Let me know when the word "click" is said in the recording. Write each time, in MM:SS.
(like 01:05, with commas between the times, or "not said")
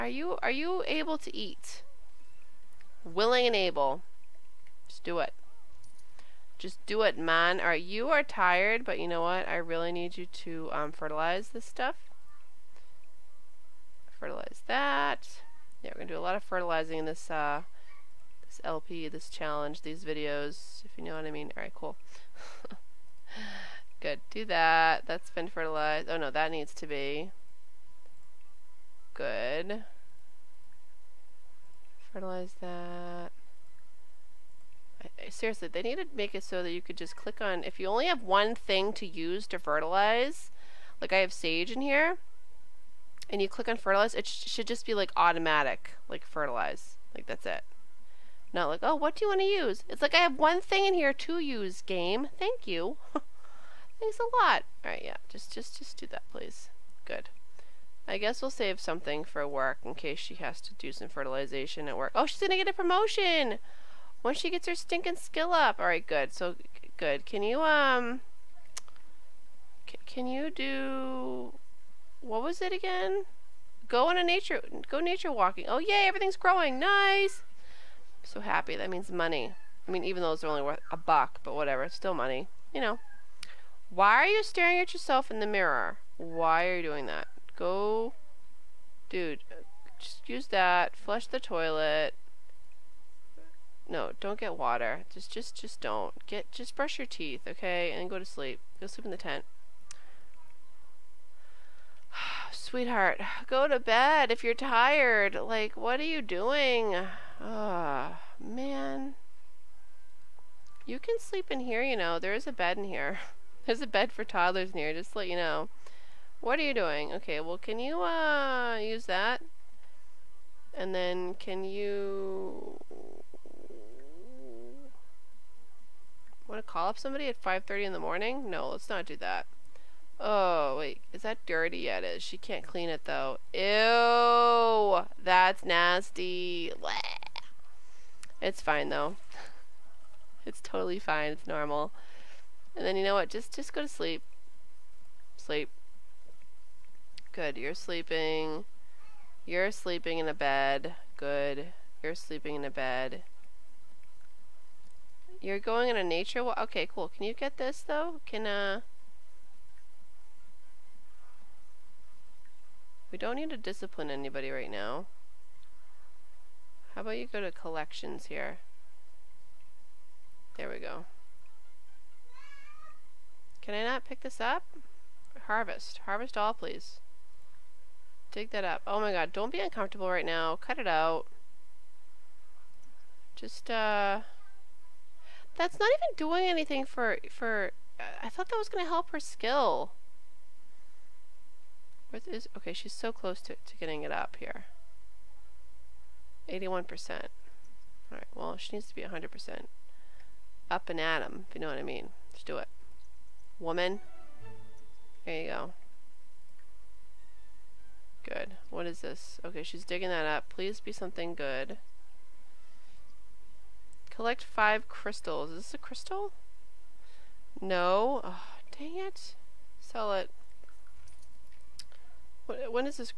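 00:37, 00:43.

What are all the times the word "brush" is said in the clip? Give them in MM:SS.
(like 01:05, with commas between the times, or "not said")
01:36.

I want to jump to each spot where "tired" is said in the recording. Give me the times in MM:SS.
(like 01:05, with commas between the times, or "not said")
00:08, 01:44.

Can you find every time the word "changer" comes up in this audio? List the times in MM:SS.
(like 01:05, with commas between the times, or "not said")
not said.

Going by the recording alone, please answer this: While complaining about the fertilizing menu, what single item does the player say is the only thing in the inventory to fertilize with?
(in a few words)
Sage.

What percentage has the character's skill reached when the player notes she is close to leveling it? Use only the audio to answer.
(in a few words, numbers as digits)
81%.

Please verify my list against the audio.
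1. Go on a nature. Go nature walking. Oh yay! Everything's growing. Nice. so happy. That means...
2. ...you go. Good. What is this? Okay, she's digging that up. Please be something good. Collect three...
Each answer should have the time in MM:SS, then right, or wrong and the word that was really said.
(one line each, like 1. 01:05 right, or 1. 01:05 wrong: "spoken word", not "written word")
1. 01:13 right
2. 03:25 wrong: "five", not "three".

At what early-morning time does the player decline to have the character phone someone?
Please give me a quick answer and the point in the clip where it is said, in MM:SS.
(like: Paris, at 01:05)
5:30, at 02:07.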